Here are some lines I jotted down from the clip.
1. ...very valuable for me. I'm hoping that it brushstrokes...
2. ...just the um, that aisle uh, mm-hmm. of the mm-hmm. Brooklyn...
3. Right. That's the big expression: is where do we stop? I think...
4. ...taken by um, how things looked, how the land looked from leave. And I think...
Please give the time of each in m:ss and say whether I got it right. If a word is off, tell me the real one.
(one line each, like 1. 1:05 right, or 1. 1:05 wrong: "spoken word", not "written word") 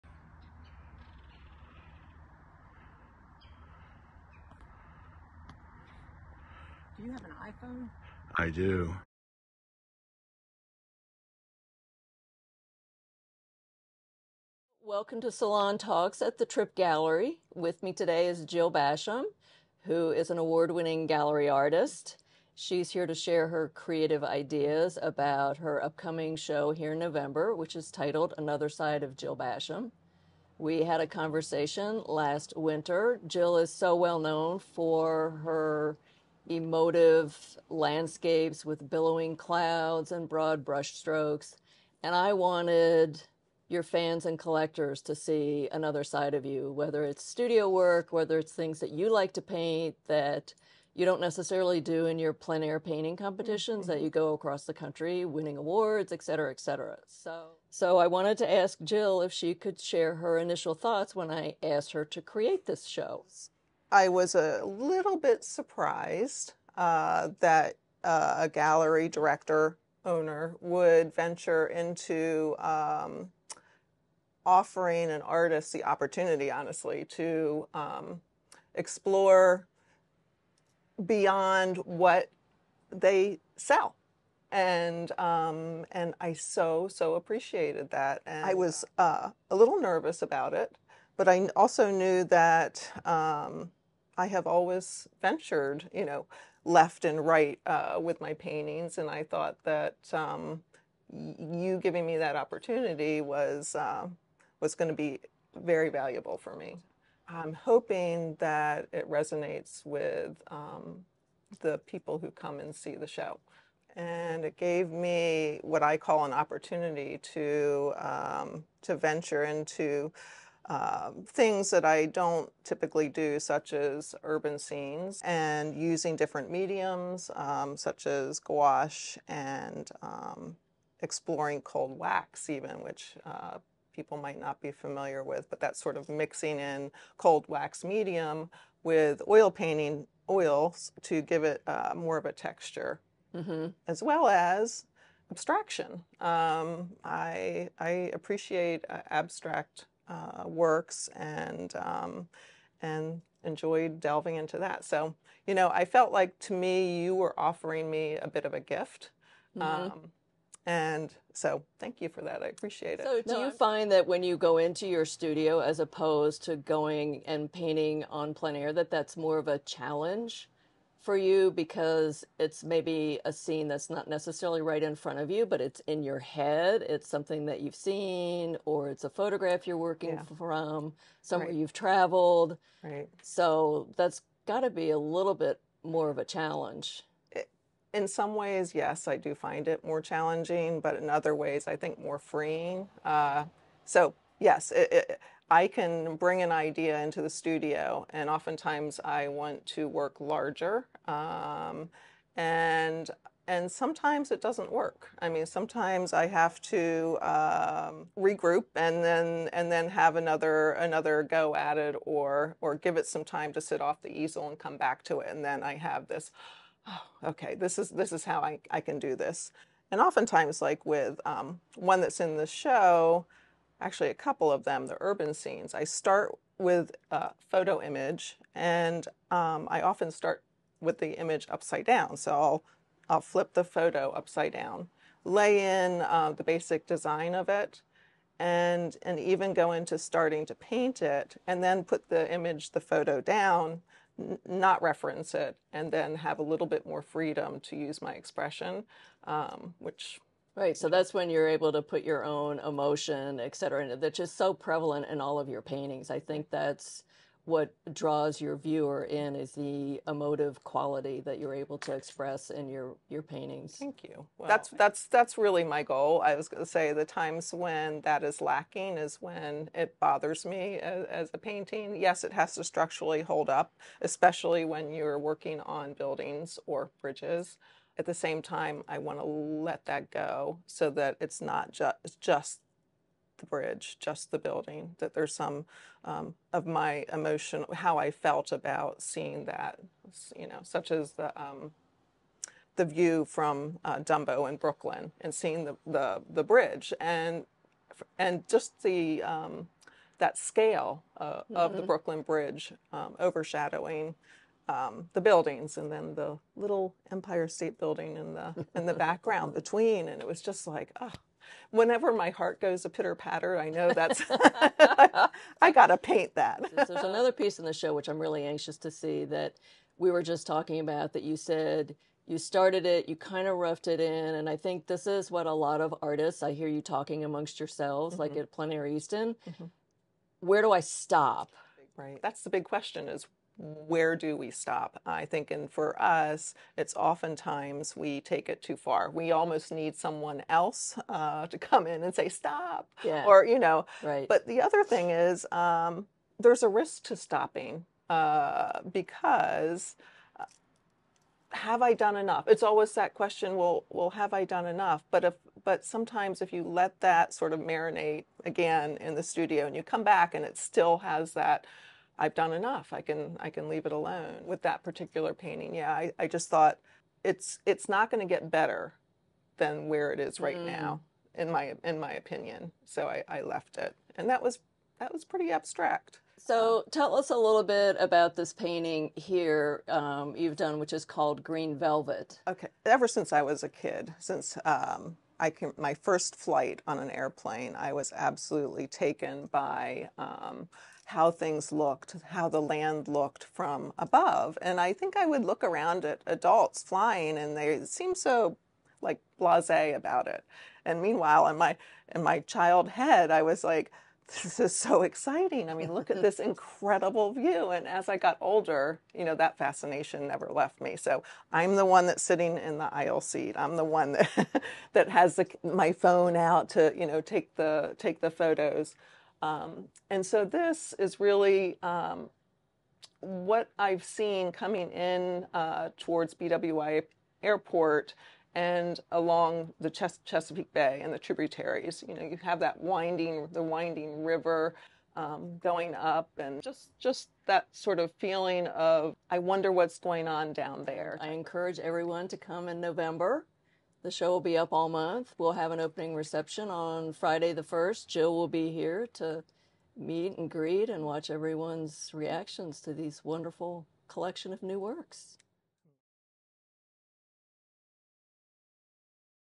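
1. 1:45 wrong: "resonates", not "brushstrokes"
2. 4:58 wrong: "scale", not "aisle"
3. 5:31 wrong: "question", not "expression"
4. 6:28 wrong: "above", not "leave".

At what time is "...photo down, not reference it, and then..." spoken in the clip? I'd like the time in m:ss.
4:02.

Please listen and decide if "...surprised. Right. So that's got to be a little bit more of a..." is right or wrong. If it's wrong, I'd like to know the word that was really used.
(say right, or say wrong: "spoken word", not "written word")
wrong: "traveled", not "surprised".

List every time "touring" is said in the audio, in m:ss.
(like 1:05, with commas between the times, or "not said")
not said.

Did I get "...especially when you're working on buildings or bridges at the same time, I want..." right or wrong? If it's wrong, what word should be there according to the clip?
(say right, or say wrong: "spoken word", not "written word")
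right.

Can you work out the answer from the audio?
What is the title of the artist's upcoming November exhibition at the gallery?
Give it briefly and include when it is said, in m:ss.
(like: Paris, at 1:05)
Another Side of Jill Basham, at 0:28.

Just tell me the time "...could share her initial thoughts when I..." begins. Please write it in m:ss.
0:59.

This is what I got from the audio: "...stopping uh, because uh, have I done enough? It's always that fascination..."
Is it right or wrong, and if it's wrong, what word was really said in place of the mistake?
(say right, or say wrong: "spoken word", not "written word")
wrong: "question", not "fascination".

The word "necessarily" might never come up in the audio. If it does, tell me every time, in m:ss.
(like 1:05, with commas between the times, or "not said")
0:51, 2:54.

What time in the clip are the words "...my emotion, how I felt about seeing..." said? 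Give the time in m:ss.
4:46.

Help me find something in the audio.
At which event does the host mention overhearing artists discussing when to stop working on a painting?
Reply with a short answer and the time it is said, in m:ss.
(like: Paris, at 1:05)
Plein Air Easton, at 5:28.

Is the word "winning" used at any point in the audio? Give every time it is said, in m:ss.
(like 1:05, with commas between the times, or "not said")
0:20, 0:55.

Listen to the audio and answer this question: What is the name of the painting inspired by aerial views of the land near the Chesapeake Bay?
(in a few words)
Green Velvet.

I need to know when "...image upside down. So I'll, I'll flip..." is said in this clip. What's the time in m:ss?
3:51.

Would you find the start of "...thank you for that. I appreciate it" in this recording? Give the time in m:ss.
2:41.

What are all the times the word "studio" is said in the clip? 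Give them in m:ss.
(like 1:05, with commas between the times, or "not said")
0:47, 2:45, 3:17, 5:59.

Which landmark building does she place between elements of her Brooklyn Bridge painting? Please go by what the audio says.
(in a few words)
Empire State Building.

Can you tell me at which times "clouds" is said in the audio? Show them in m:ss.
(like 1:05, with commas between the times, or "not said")
0:39.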